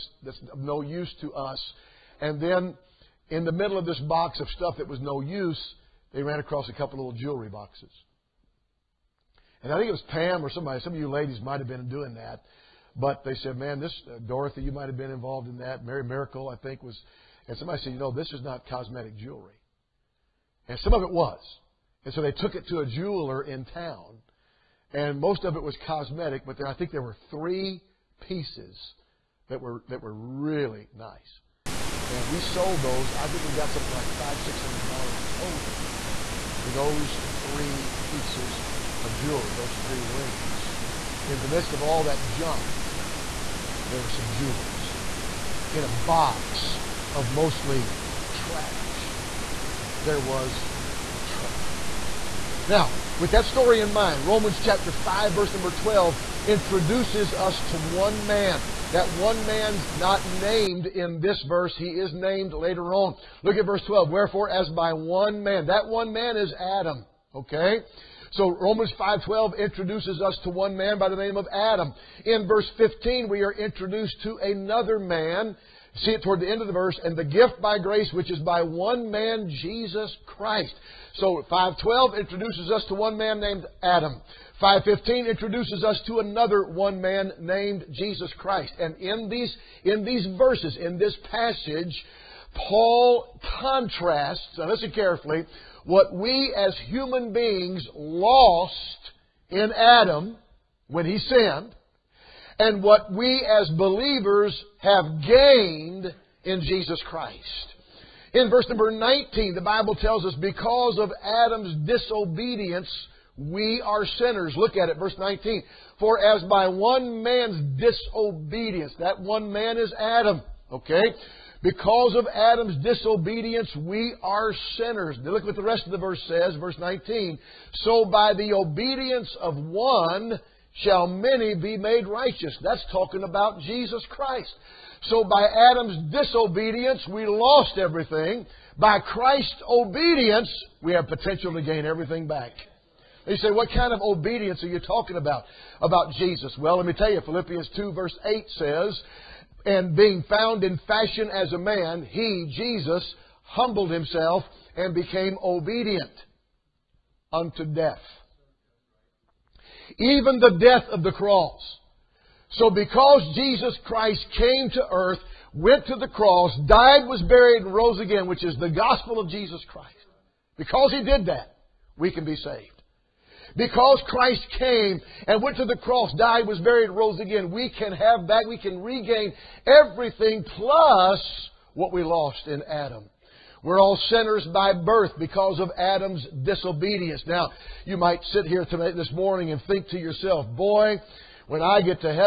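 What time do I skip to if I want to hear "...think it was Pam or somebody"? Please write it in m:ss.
0:09.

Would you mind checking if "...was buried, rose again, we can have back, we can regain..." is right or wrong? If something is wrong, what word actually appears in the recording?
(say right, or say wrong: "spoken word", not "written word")
right.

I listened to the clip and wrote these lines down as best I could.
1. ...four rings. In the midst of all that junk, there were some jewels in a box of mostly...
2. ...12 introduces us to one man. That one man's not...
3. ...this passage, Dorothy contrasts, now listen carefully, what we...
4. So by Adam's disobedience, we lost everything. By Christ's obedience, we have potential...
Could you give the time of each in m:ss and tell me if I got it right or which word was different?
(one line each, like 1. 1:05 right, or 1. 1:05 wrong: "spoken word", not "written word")
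1. 0:39 wrong: "three", not "four"
2. 0:55 right
3. 1:30 wrong: "Paul", not "Dorothy"
4. 2:15 right.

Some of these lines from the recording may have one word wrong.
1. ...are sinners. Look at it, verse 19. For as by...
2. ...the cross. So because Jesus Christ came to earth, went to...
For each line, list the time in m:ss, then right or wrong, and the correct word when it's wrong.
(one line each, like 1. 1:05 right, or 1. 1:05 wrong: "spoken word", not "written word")
1. 1:53 right
2. 2:41 right.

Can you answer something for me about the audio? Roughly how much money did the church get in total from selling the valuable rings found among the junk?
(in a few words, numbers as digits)
$500-600.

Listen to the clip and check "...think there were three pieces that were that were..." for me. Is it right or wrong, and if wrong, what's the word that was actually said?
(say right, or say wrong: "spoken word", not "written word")
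right.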